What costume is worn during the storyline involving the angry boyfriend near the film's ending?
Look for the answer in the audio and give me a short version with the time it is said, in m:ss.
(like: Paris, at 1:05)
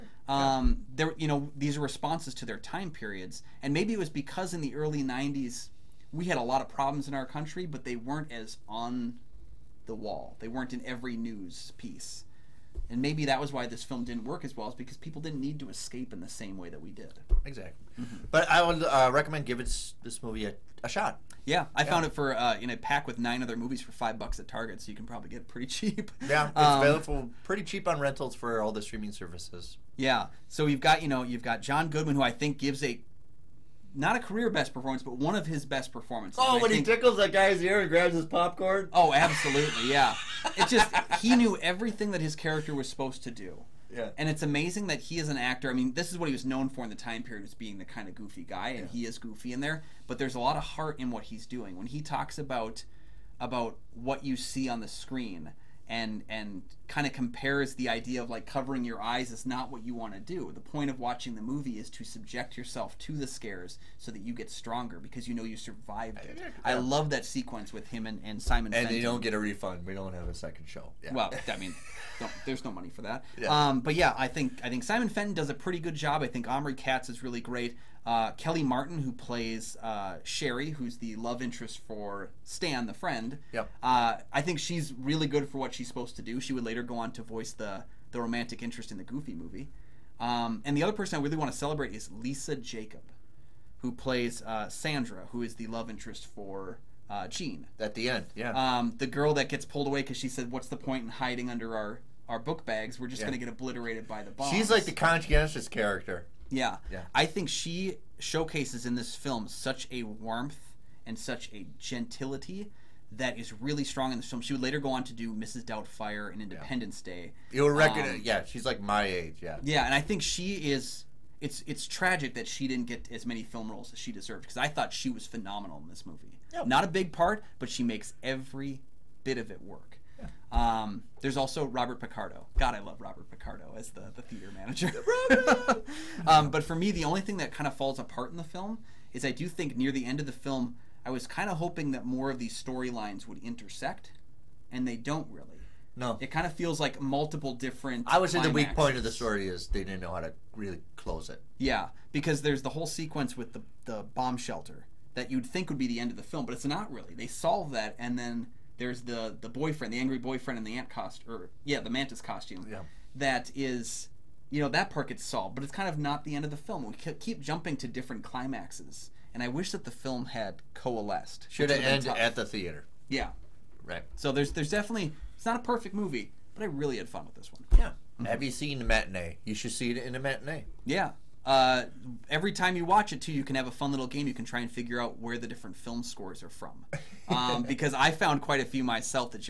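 mantis costume, at 2:41.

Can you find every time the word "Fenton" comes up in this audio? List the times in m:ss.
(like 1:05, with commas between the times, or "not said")
1:08, 1:15.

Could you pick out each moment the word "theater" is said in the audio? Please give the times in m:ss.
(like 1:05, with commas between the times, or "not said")
2:14, 2:52.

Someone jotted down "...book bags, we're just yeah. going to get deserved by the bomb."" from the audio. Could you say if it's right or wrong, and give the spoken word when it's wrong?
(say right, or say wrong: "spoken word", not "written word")
wrong: "obliterated", not "deserved".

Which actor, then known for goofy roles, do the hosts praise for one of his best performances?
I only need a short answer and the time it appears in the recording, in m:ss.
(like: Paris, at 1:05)
John Goodman, at 0:31.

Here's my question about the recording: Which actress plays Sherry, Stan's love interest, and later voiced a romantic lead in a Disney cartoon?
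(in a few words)
Kellie Martin.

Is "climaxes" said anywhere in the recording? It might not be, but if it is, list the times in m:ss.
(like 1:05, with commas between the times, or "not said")
2:48.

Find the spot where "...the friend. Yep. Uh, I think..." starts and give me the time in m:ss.
1:22.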